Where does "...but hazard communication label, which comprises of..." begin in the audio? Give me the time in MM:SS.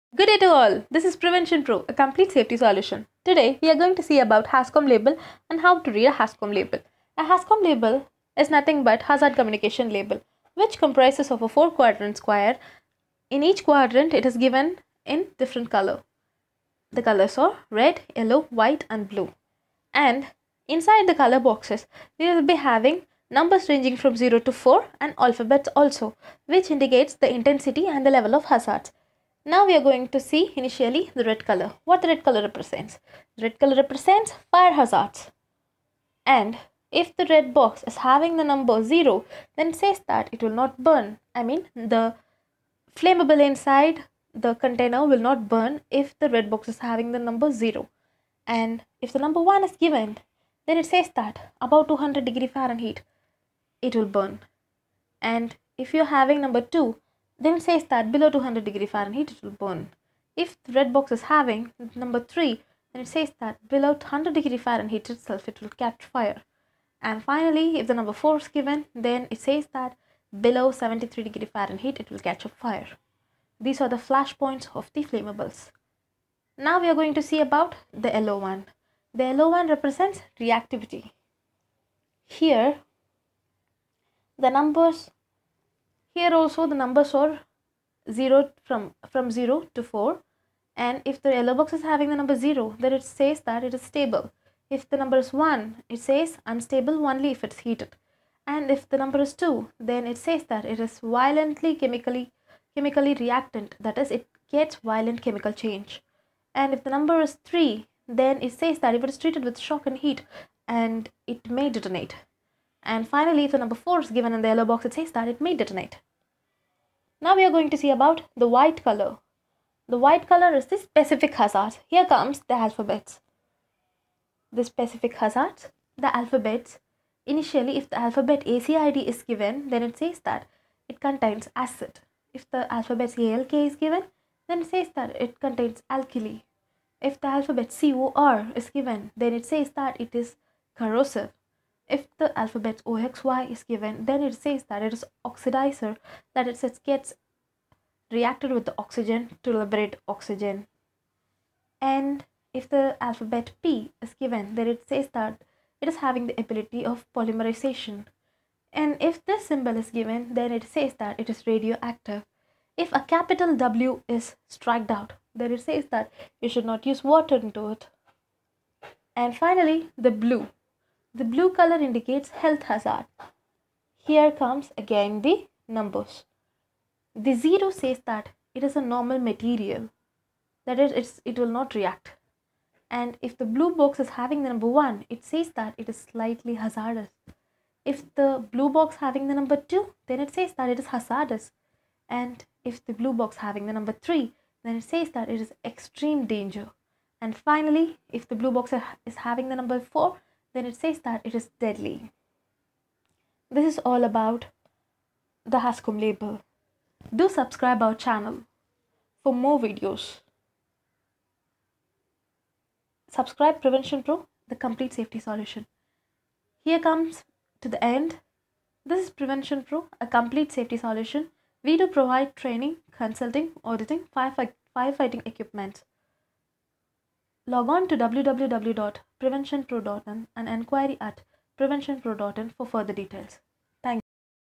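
00:08.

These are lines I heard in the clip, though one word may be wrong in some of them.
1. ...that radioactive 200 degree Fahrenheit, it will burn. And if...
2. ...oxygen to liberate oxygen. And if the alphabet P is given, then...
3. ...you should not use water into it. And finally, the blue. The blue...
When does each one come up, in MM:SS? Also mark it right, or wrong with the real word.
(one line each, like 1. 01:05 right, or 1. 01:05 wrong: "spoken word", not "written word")
1. 00:51 wrong: "above", not "radioactive"
2. 02:28 right
3. 02:46 right.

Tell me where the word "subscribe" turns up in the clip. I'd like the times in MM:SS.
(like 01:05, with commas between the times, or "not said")
03:27, 03:33.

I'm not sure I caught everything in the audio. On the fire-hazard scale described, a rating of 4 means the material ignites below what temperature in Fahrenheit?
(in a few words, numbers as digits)
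73 degrees Fahrenheit.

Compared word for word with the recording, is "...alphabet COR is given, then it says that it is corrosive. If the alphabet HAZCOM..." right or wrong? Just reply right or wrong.
wrong.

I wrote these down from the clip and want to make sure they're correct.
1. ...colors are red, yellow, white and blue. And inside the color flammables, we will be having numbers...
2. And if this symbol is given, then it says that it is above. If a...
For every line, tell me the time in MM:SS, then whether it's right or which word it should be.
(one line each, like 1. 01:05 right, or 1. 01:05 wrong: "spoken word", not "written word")
1. 00:17 wrong: "boxes", not "flammables"
2. 02:38 wrong: "radioactive", not "above".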